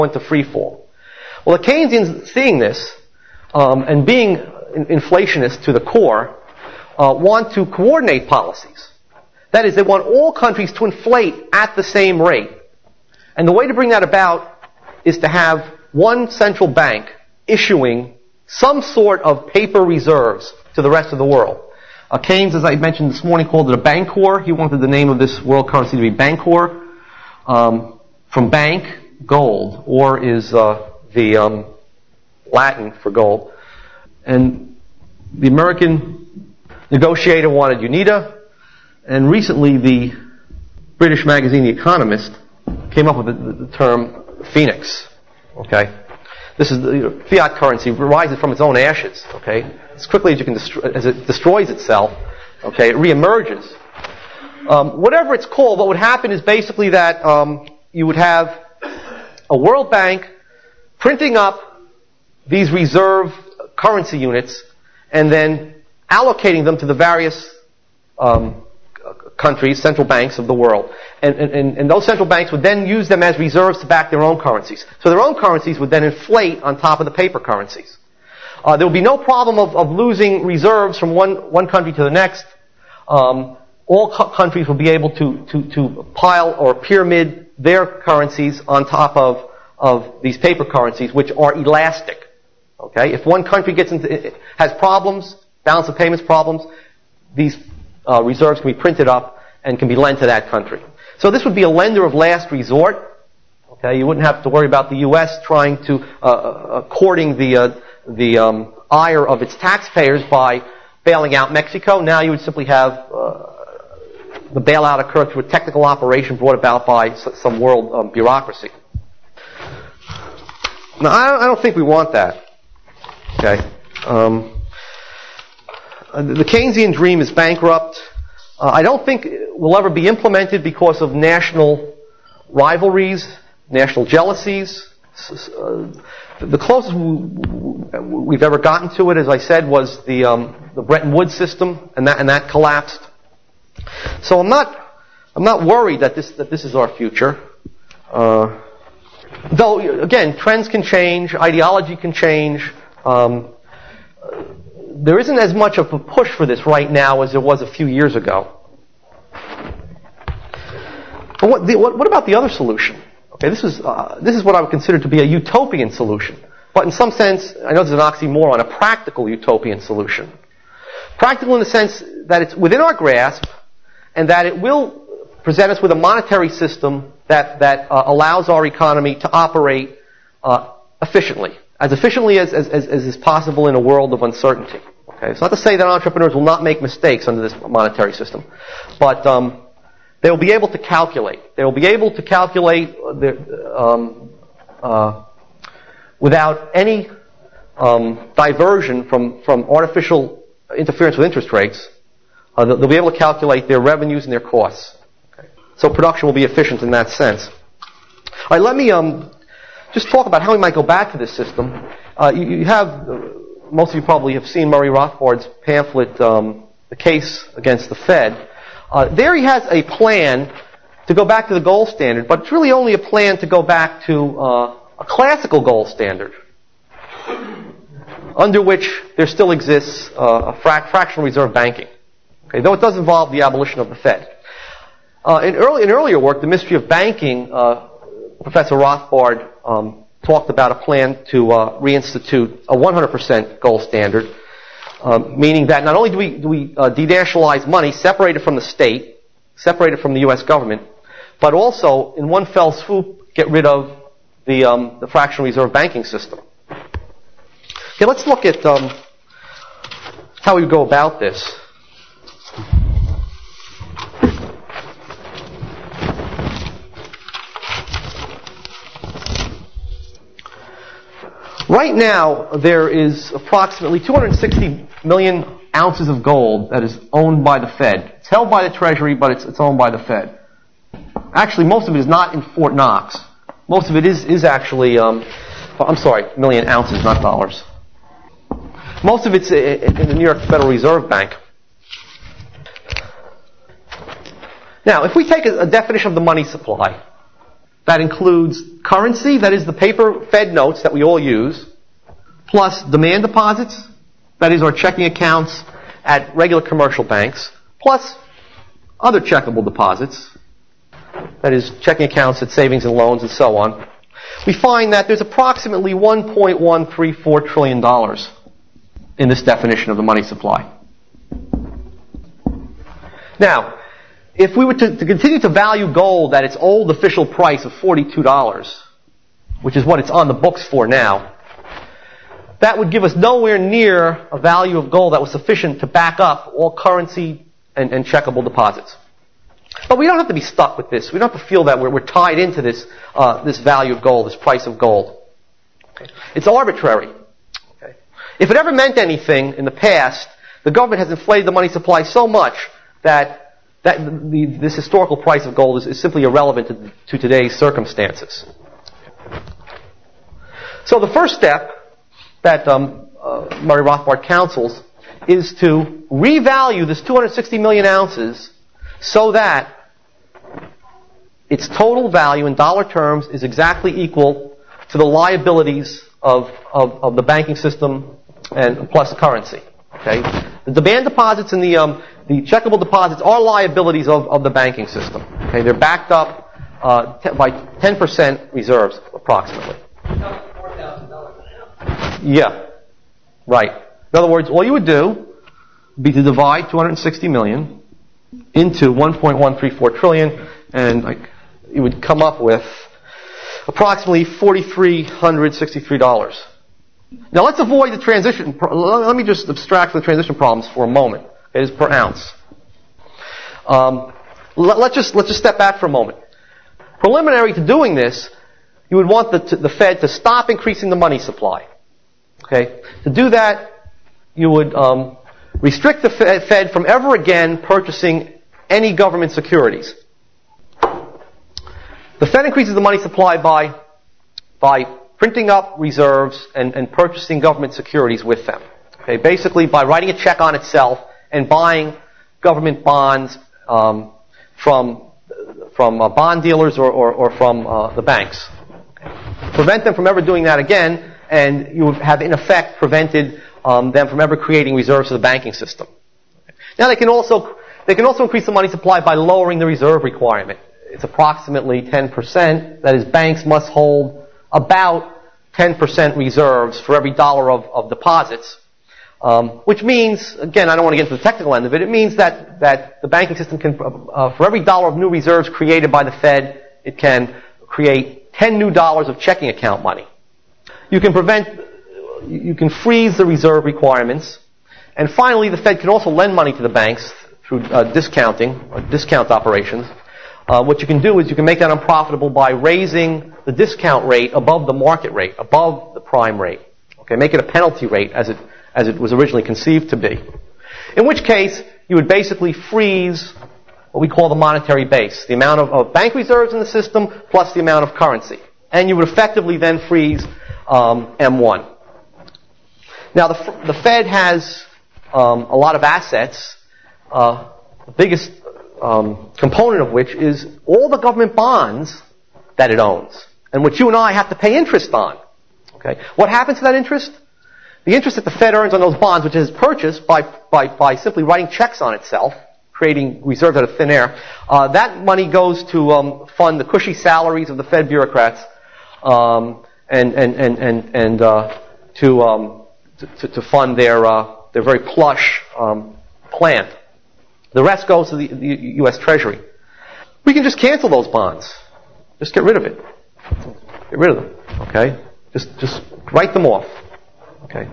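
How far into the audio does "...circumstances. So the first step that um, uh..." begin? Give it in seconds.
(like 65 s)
357 s.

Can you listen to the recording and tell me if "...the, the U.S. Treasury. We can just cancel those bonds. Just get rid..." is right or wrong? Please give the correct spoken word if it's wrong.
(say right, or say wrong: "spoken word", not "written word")
right.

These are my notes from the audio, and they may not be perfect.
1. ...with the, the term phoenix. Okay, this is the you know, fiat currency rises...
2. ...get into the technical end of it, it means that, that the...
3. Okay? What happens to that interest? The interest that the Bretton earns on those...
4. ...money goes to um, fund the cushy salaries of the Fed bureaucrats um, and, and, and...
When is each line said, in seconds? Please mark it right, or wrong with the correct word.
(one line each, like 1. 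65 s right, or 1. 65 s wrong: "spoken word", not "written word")
1. 43 s right
2. 470 s right
3. 525 s wrong: "Fed", not "Bretton"
4. 535 s right.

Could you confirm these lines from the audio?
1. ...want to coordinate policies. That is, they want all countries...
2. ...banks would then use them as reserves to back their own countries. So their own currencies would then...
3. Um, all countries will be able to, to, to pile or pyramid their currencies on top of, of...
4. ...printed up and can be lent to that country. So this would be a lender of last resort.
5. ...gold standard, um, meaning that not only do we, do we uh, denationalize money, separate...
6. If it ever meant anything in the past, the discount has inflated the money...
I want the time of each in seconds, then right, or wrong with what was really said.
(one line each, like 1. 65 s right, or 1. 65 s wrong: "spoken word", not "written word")
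1. 7 s right
2. 72 s wrong: "currencies", not "countries"
3. 83 s right
4. 98 s right
5. 243 s right
6. 348 s wrong: "government", not "discount".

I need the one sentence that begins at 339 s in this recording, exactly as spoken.
But we don't have to be stuck with this.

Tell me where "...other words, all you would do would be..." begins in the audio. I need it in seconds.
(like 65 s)
394 s.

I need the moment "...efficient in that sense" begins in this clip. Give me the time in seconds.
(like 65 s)
206 s.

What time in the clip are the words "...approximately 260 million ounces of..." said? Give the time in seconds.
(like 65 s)
273 s.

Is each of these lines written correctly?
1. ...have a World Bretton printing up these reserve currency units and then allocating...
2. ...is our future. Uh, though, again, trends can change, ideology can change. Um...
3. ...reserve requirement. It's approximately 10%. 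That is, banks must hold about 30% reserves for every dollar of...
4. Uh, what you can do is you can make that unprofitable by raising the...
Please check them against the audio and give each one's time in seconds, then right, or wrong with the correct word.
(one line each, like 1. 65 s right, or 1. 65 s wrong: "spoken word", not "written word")
1. 58 s wrong: "Bank", not "Bretton"
2. 146 s right
3. 459 s wrong: "10", not "30"
4. 490 s right.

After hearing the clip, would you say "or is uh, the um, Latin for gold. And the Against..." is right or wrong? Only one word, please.
wrong.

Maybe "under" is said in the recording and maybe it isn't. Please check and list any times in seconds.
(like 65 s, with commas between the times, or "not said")
187 s, 228 s.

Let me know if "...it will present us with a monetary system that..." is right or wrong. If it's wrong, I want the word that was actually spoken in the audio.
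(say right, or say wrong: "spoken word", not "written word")
right.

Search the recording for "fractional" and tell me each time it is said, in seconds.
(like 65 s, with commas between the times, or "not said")
230 s, 255 s.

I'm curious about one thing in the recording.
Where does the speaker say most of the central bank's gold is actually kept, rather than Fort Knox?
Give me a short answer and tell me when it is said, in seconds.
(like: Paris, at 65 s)
New York Federal Reserve Bank, at 290 s.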